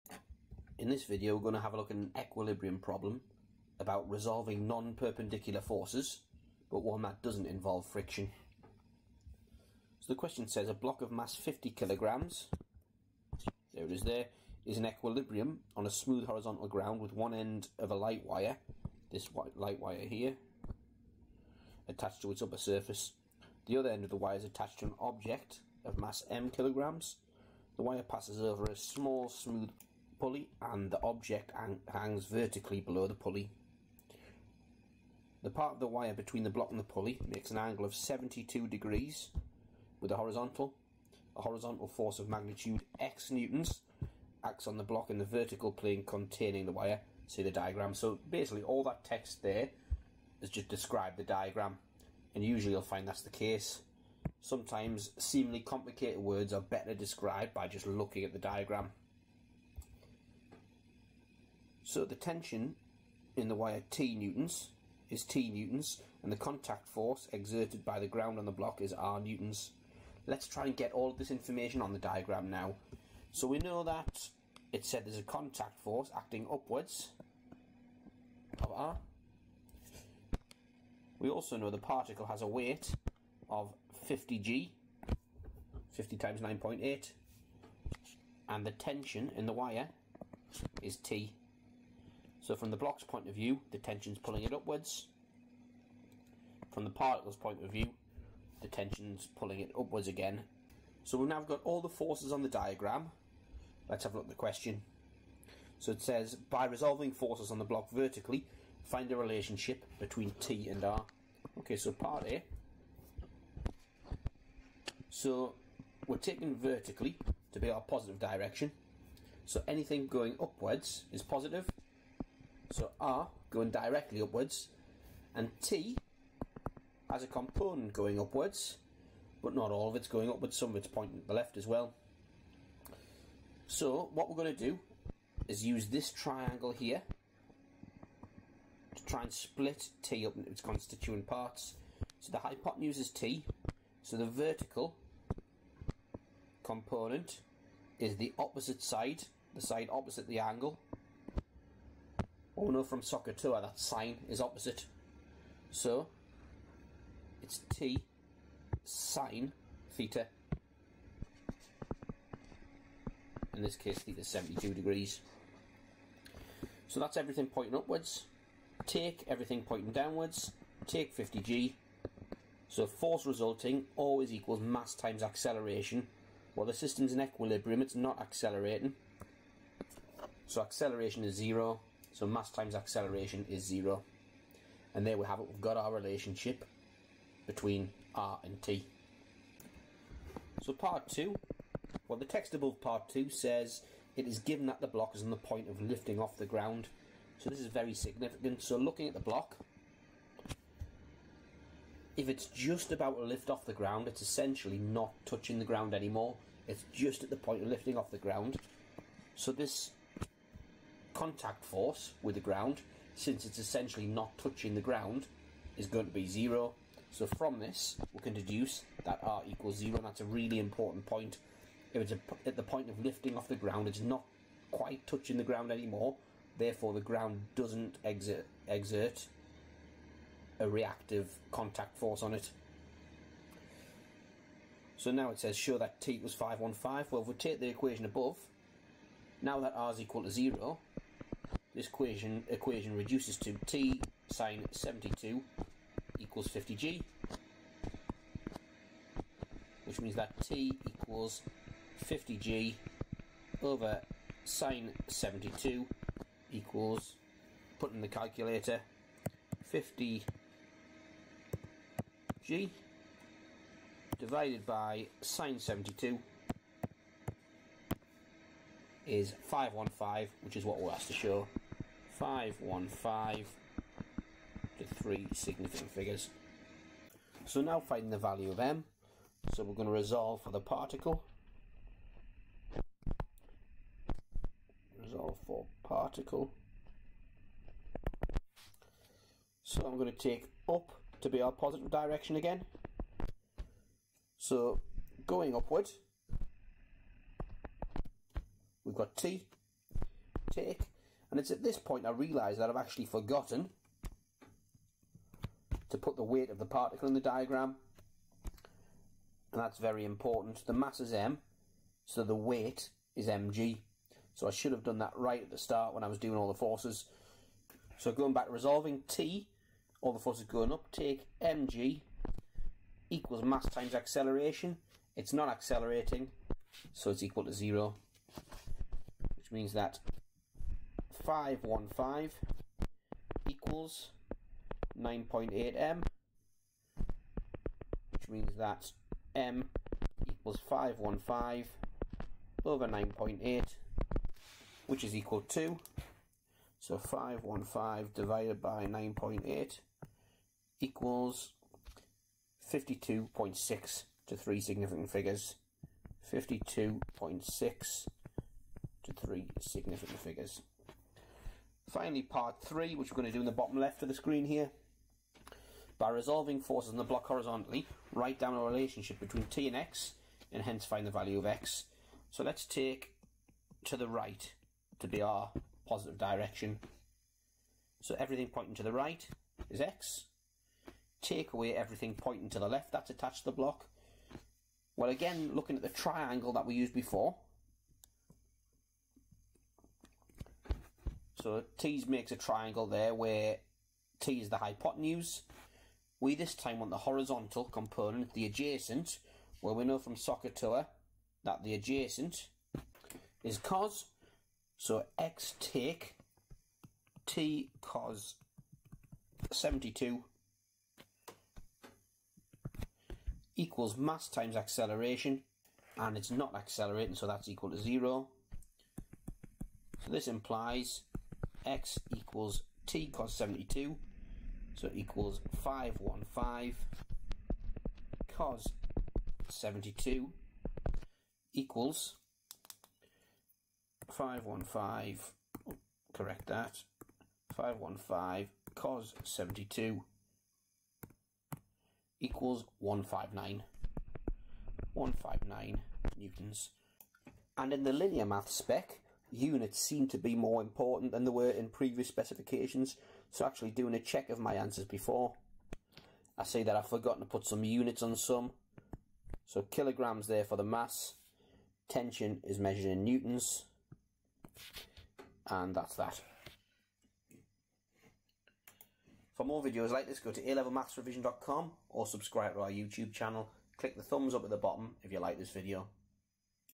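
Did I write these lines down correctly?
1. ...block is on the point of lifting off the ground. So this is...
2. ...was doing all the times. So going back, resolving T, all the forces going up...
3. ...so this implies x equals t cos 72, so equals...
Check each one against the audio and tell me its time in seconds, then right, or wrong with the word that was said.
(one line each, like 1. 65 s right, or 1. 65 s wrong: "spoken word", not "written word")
1. 194 s right
2. 316 s wrong: "forces", not "times"
3. 420 s right.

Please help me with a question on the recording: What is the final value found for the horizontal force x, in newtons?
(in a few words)
159.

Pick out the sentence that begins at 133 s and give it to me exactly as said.
So what we're going to do is use this triangle here to try and split T up into its constituent parts.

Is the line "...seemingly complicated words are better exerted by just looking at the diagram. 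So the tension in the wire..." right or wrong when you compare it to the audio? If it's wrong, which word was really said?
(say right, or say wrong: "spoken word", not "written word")
wrong: "described", not "exerted".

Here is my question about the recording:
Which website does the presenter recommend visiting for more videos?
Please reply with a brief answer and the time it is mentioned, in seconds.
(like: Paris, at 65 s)
alevelmathsrevision.com, at 470 s.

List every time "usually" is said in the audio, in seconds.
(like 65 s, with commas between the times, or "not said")
52 s.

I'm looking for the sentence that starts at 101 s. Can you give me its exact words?
So we've now got all the forces on the diagram.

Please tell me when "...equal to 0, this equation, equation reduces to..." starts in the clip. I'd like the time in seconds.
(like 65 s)
239 s.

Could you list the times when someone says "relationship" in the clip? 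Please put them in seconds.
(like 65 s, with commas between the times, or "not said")
109 s, 185 s, 368 s.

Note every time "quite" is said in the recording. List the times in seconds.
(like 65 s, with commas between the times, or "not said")
224 s.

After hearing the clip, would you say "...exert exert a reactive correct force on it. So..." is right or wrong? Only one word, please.
wrong.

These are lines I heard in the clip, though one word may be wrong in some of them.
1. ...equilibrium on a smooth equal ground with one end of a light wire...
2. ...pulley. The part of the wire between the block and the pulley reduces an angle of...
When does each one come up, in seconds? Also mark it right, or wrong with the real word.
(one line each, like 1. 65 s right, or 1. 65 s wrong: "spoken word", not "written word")
1. 14 s wrong: "horizontal", not "equal"
2. 33 s wrong: "makes", not "reduces".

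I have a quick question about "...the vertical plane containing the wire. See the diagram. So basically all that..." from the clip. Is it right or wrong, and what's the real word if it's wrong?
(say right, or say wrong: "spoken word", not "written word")
right.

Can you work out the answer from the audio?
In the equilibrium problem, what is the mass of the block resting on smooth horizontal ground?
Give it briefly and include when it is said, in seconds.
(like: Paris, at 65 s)
50 kilograms, at 11 s.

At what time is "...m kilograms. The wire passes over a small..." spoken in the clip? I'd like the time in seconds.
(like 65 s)
26 s.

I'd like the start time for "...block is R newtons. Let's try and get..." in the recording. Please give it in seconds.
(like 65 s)
68 s.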